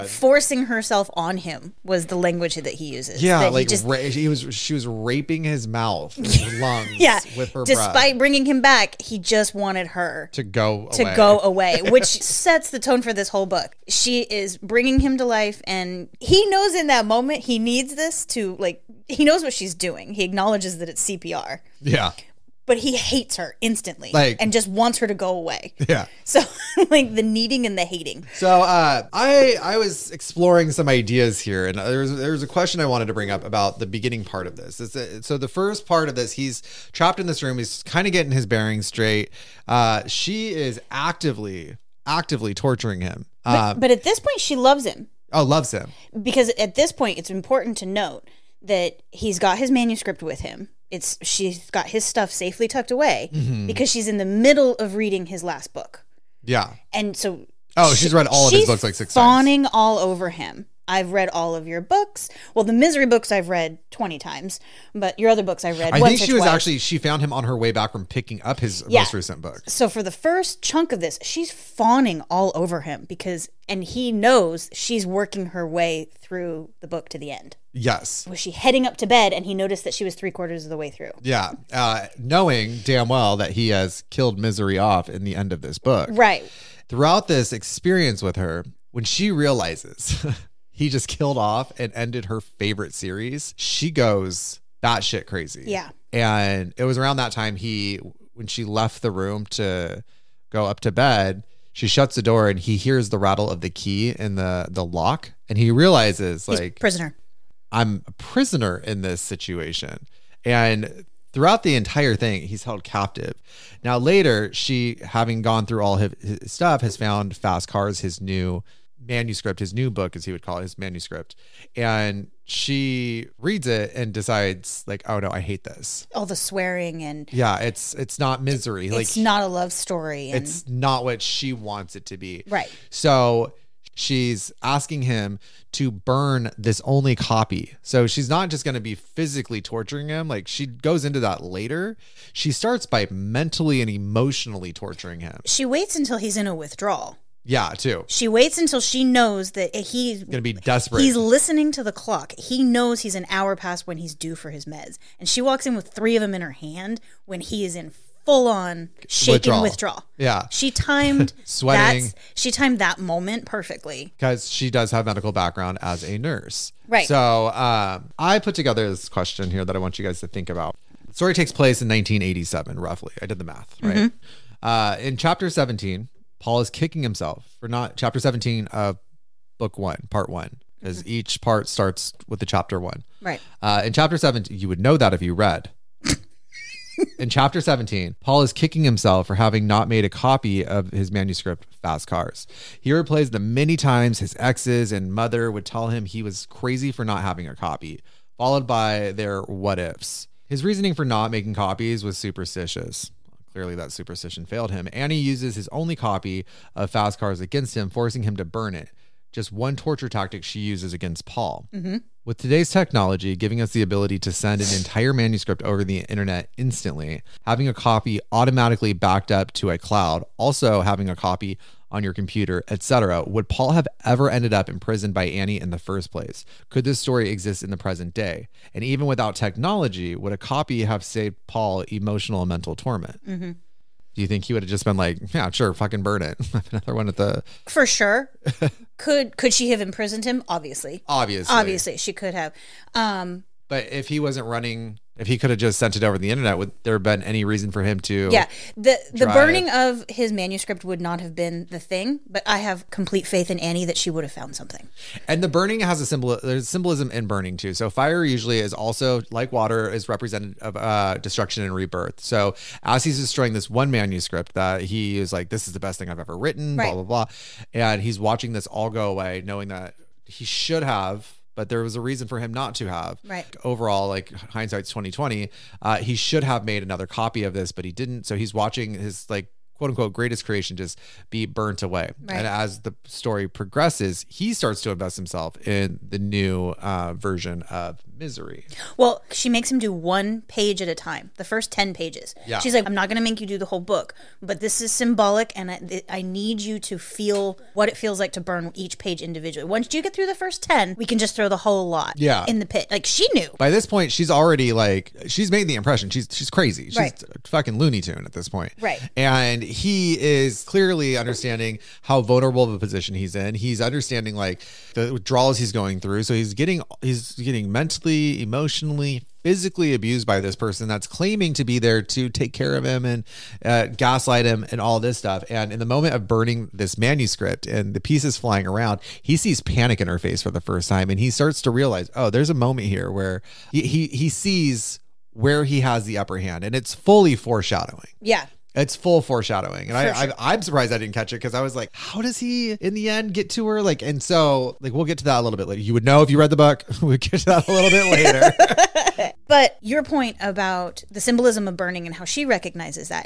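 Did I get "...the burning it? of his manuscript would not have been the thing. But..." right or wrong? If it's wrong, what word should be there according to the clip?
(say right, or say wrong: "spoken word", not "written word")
right.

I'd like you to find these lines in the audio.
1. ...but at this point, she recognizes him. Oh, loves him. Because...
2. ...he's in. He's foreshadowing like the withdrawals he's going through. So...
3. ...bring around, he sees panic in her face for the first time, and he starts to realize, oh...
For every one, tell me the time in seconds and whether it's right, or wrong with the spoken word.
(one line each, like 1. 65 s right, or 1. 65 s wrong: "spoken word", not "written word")
1. 43 s wrong: "loves", not "recognizes"
2. 313 s wrong: "understanding", not "foreshadowing"
3. 328 s wrong: "flying", not "bring".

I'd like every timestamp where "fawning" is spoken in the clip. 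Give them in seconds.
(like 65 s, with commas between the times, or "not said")
59 s, 71 s.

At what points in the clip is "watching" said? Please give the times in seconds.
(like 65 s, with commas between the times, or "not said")
268 s, 278 s.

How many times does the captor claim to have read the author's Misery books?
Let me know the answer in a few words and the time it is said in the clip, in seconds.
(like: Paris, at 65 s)
20, at 63 s.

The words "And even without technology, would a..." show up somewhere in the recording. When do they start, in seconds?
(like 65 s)
228 s.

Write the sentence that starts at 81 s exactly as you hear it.
Uh, knowing damn well that he has killed misery off in the end of this book.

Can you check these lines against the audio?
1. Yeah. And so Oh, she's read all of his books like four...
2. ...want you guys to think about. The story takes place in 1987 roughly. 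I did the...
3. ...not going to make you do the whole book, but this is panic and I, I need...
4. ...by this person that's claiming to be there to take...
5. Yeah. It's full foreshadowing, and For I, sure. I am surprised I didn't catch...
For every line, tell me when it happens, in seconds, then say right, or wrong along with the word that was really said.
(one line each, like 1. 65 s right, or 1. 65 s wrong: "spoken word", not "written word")
1. 56 s wrong: "six", not "four"
2. 169 s right
3. 292 s wrong: "symbolic", not "panic"
4. 320 s right
5. 338 s right.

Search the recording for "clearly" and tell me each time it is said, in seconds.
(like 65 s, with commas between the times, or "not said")
203 s, 310 s.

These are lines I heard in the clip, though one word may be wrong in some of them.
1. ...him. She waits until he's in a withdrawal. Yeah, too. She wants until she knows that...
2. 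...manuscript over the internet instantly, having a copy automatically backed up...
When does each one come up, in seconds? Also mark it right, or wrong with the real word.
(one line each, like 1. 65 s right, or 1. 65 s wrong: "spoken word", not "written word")
1. 145 s wrong: "waits", not "wants"
2. 215 s right.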